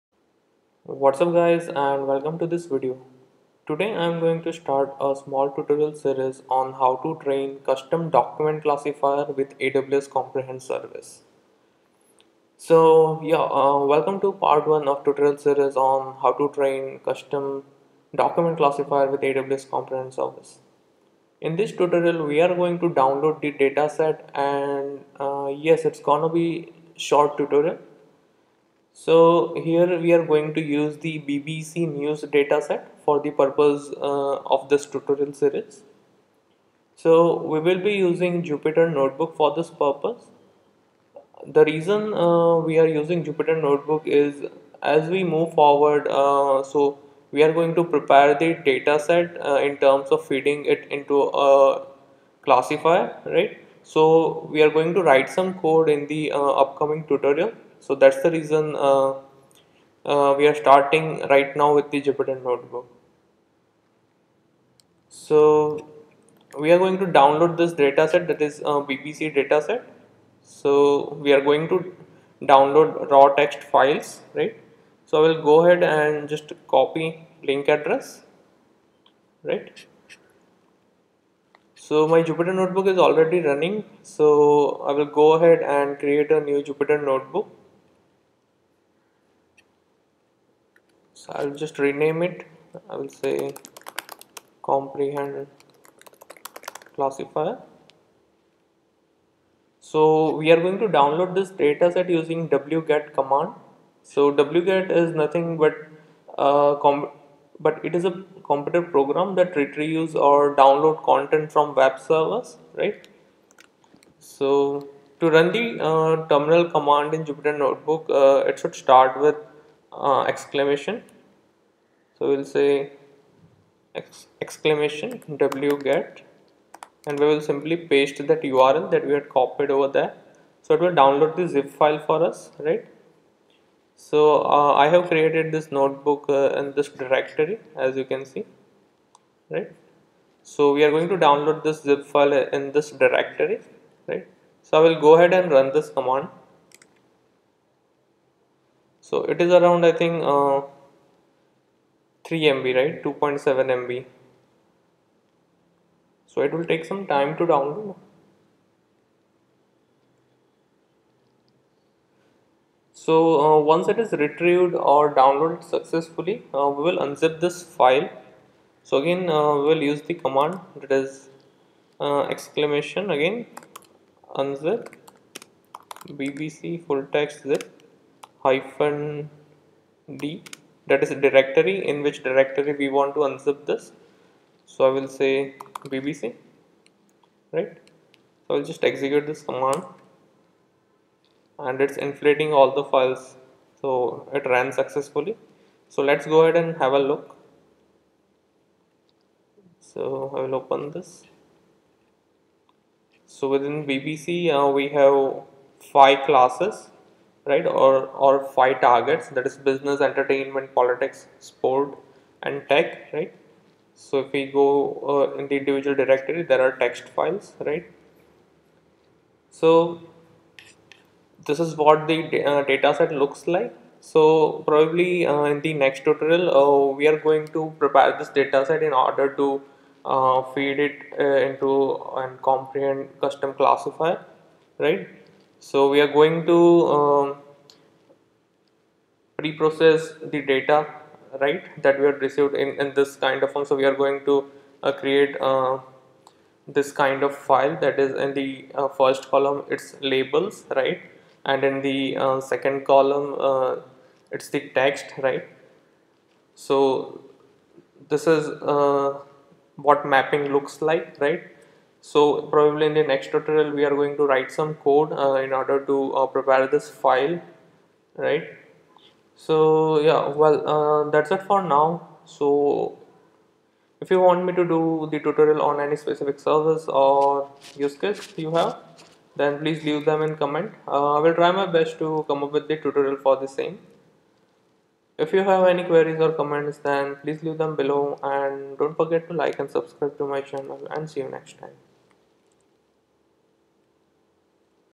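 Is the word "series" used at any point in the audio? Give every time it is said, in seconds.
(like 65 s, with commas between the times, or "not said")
5 s, 15 s, 35 s.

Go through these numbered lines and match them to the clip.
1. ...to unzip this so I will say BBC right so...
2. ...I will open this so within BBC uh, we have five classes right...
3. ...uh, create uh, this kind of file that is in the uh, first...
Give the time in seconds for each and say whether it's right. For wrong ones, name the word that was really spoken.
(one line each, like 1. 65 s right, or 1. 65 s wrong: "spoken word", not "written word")
1. 183 s right
2. 200 s right
3. 244 s right.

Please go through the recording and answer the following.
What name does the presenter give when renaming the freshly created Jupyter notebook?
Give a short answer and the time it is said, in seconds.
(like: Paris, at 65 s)
comprehend classifier, at 94 s.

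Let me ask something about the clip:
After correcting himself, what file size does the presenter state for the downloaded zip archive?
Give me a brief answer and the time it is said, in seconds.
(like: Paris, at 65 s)
2.7 MB, at 153 s.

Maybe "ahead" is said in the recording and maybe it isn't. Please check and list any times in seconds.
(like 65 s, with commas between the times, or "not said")
75 s, 85 s, 145 s, 196 s.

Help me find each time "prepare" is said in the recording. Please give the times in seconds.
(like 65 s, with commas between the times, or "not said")
47 s, 227 s, 266 s.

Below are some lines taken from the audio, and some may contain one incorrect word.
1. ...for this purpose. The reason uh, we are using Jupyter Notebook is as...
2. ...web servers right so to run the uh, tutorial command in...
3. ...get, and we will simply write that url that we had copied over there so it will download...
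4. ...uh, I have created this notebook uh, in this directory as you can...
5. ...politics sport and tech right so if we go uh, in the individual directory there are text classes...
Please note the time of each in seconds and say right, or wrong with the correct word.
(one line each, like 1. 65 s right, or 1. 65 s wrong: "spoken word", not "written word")
1. 39 s right
2. 111 s wrong: "terminal", not "tutorial"
3. 125 s wrong: "paste", not "write"
4. 134 s right
5. 210 s wrong: "files", not "classes".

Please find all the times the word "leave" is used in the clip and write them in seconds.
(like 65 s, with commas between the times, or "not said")
279 s, 287 s.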